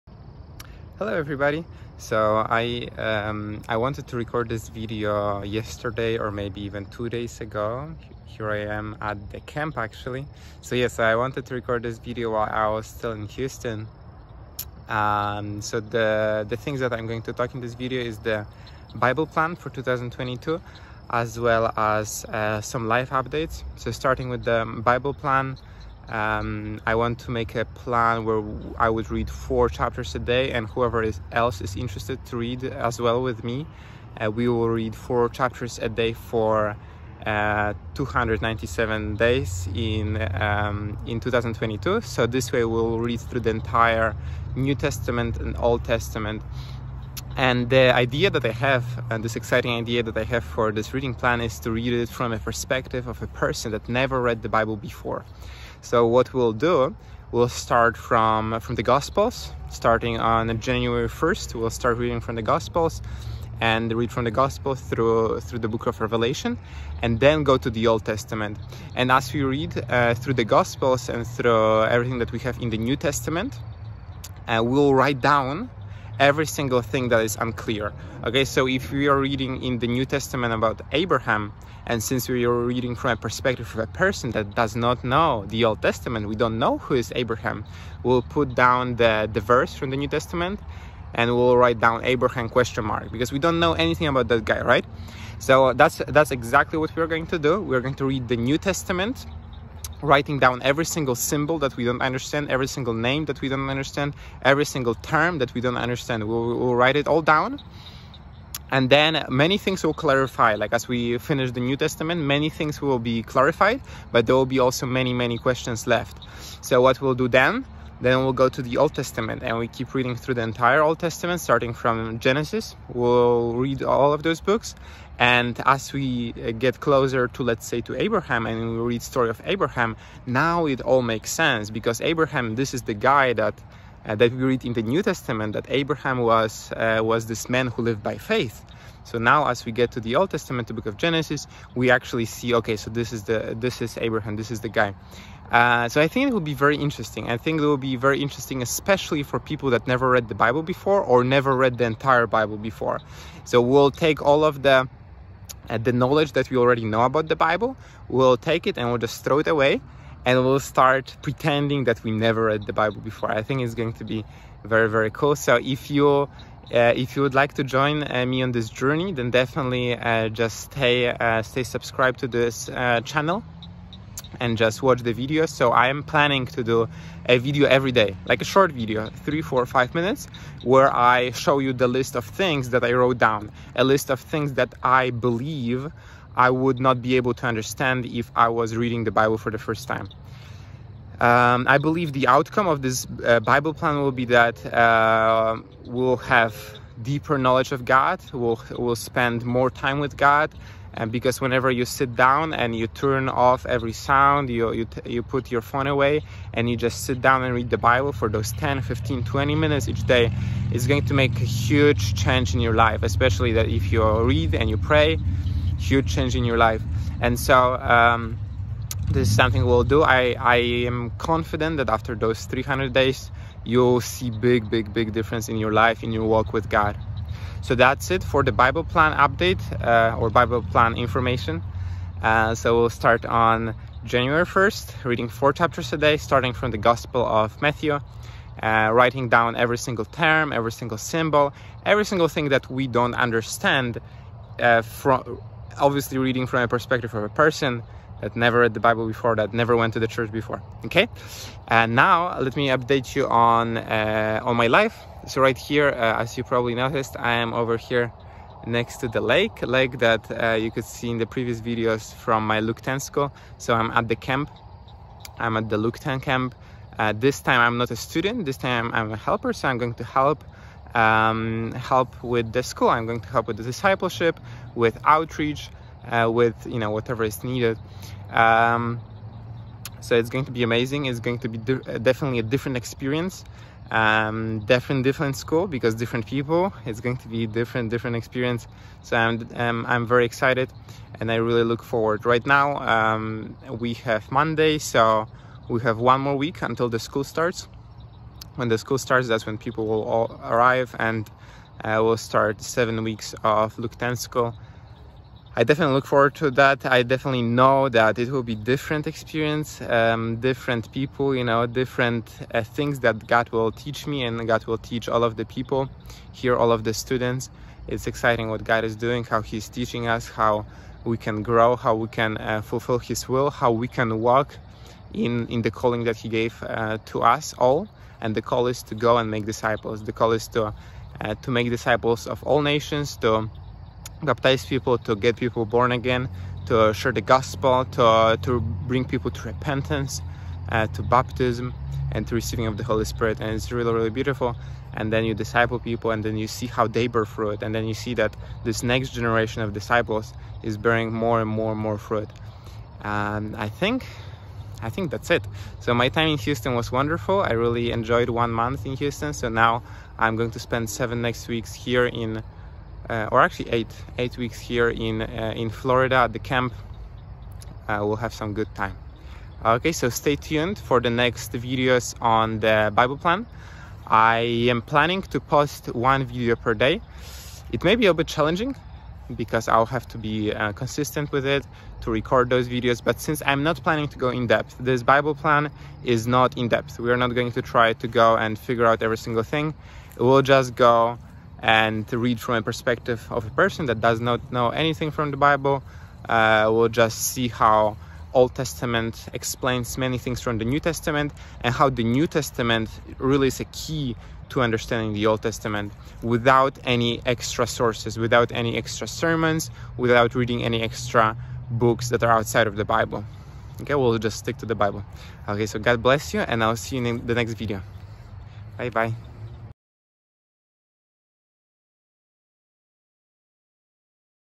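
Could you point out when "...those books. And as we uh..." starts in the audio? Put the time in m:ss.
2:04.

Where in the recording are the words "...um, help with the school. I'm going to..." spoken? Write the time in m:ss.
4:30.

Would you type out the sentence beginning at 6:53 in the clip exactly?
Okay, we'll just stick to the Bible.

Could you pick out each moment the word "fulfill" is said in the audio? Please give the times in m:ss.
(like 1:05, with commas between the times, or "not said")
5:22.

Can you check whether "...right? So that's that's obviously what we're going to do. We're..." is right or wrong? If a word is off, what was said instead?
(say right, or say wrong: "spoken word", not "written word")
wrong: "exactly", not "obviously".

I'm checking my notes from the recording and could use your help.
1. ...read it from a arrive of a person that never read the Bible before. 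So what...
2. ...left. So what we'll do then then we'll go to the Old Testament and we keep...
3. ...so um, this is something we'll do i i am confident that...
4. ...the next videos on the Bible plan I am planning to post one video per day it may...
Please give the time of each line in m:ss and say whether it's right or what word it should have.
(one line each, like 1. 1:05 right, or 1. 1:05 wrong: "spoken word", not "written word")
1. 0:51 wrong: "perspective", not "arrive"
2. 1:55 right
3. 3:37 right
4. 6:11 right.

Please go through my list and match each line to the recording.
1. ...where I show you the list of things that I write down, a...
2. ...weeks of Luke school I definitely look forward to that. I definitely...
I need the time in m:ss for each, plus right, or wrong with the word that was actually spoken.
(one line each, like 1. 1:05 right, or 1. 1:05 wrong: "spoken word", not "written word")
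1. 3:00 wrong: "wrote", not "write"
2. 5:03 right.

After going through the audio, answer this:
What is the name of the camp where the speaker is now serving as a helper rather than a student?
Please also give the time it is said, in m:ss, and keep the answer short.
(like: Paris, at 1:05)
Lukten camp, at 4:25.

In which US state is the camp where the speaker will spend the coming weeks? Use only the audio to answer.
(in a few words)
Florida.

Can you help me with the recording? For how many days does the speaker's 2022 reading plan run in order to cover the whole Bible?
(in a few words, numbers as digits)
297.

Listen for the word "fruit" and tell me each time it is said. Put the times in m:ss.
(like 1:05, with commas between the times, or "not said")
5:47, 5:51.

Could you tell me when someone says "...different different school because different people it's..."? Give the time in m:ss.
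4:44.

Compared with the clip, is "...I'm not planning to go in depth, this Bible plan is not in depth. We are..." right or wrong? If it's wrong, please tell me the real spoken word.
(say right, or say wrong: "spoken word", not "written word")
right.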